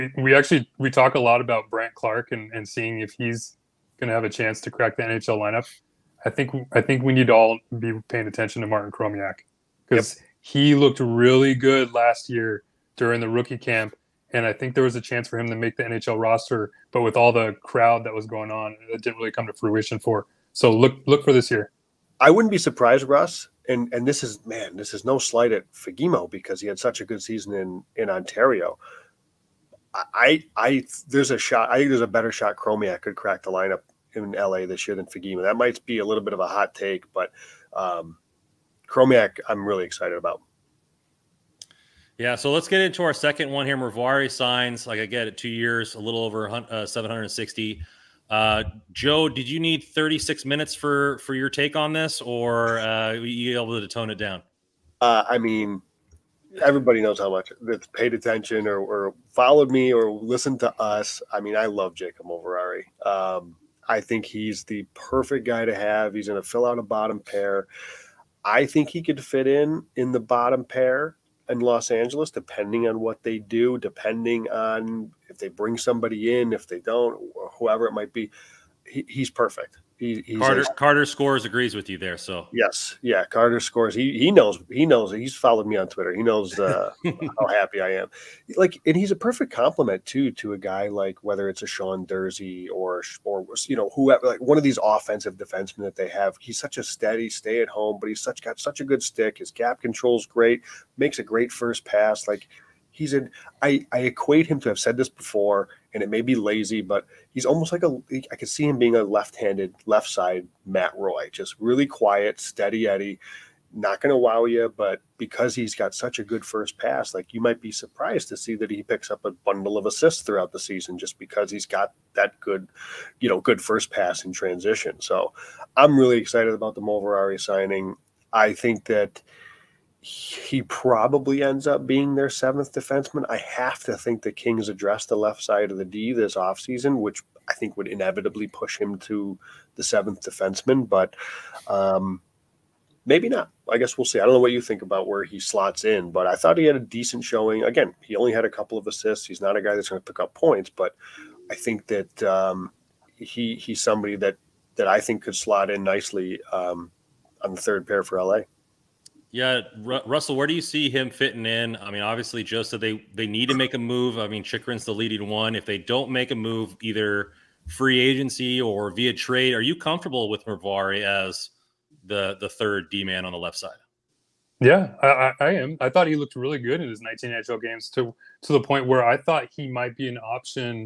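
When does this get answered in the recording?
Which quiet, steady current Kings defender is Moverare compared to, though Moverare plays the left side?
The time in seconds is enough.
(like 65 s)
110 s.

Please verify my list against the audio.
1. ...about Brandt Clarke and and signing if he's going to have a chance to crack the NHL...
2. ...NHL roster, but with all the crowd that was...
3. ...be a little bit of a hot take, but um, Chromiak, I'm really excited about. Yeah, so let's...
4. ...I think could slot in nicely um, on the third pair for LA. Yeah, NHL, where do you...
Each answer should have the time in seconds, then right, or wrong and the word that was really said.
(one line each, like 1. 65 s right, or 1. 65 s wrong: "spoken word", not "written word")
1. 1 s wrong: "seeing", not "signing"
2. 15 s right
3. 35 s right
4. 154 s wrong: "Russell", not "NHL".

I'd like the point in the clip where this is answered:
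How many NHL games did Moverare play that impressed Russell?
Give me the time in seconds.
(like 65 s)
177 s.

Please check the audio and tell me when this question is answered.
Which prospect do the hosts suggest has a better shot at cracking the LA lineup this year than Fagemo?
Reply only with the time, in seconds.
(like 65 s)
8 s.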